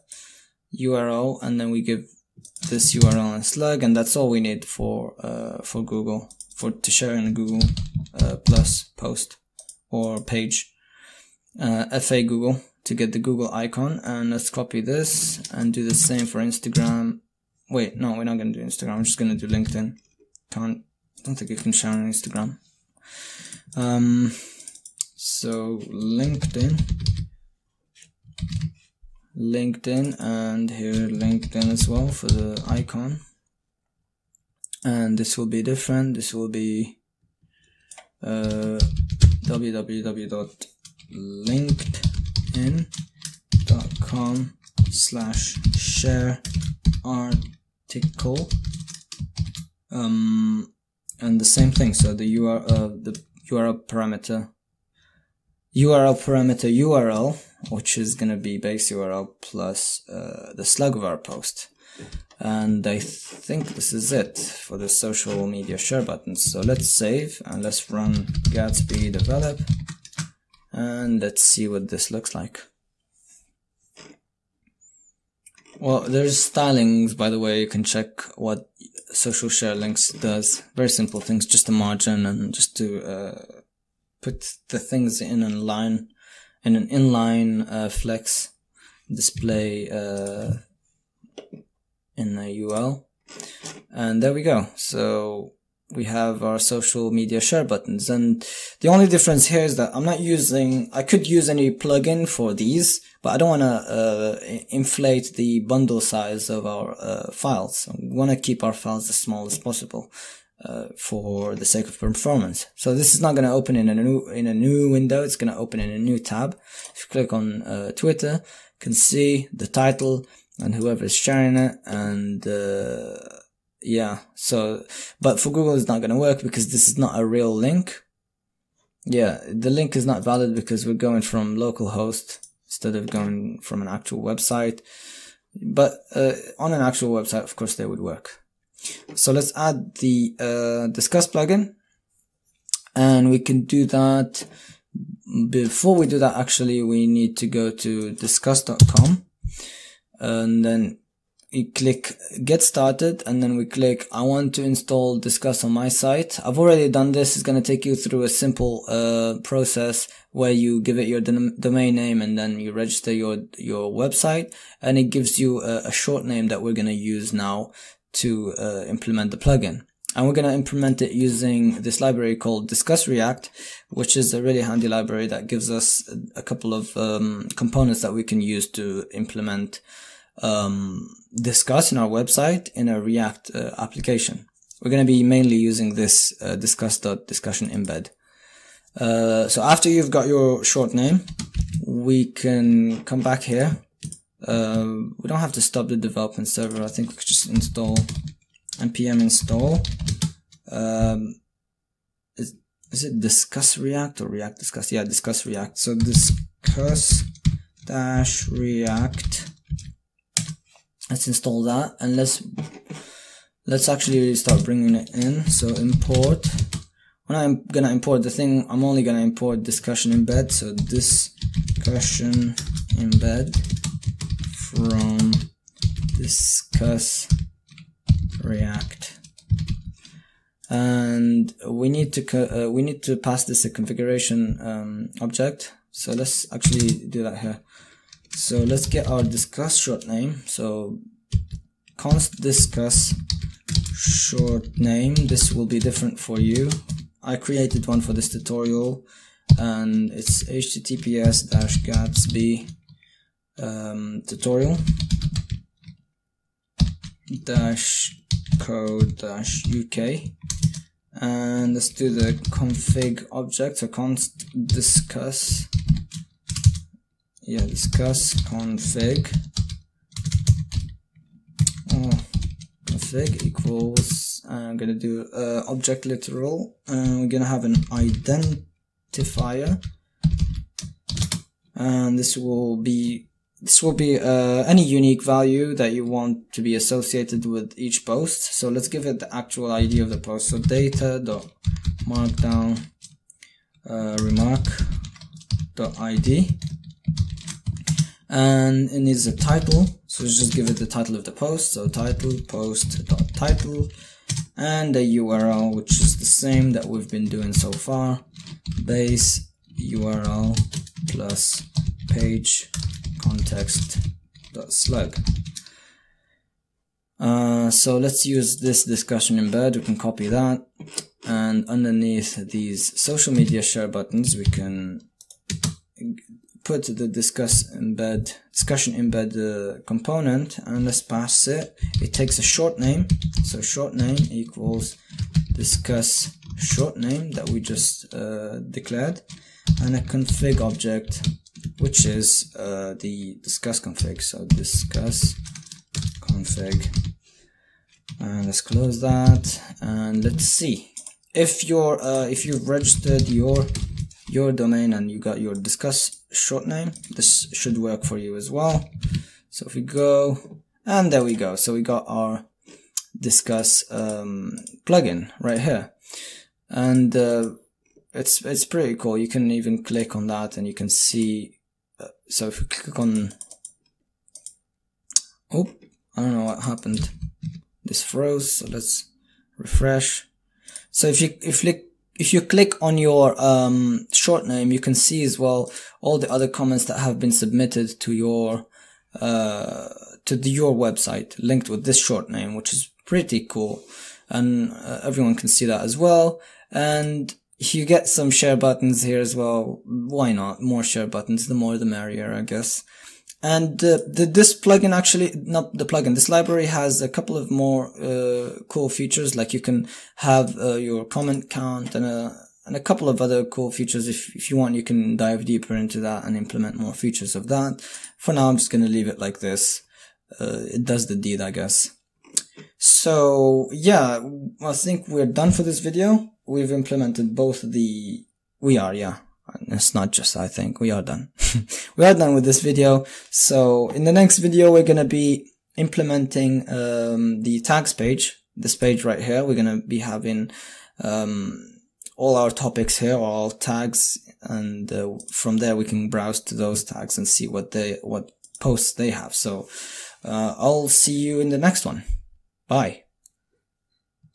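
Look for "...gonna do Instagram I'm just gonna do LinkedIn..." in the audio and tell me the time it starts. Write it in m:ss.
0:18.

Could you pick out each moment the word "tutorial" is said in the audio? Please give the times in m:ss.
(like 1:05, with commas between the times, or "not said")
4:08, 4:14.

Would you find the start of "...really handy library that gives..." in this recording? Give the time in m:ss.
2:54.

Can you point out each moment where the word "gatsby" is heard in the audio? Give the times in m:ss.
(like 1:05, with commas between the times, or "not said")
1:08, 4:11.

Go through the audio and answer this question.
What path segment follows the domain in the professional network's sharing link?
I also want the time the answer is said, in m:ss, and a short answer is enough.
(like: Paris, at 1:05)
share article, at 0:45.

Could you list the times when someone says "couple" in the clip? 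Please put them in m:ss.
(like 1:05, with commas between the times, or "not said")
2:56, 6:47, 6:52.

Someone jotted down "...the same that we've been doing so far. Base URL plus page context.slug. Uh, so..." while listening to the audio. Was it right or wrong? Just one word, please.
right.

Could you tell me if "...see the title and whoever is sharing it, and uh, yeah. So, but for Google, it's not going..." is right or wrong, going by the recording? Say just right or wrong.
right.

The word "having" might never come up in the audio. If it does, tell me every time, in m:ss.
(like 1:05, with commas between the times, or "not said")
7:20.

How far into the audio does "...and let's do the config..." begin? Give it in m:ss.
4:21.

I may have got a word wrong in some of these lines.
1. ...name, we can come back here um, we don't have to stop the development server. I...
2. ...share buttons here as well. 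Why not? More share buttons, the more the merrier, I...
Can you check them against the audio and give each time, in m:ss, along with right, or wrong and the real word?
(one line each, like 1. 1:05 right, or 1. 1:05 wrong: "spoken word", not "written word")
1. 3:10 right
2. 6:38 right.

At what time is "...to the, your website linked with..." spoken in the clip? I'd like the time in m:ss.
6:30.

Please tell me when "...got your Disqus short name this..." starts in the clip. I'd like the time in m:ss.
5:55.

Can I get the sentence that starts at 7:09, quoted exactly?
It's not just I think, we are done.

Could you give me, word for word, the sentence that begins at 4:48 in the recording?
So let's give it the actual ID of the post.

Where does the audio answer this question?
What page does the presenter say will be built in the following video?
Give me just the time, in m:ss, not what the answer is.
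7:17.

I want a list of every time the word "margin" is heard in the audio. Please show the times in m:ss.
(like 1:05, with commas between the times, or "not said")
1:21.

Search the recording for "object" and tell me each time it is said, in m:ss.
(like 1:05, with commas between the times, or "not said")
3:55, 4:23, 4:35, 5:40.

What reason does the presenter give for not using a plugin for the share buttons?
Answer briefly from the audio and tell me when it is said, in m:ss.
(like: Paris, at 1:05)
bundle size, at 1:45.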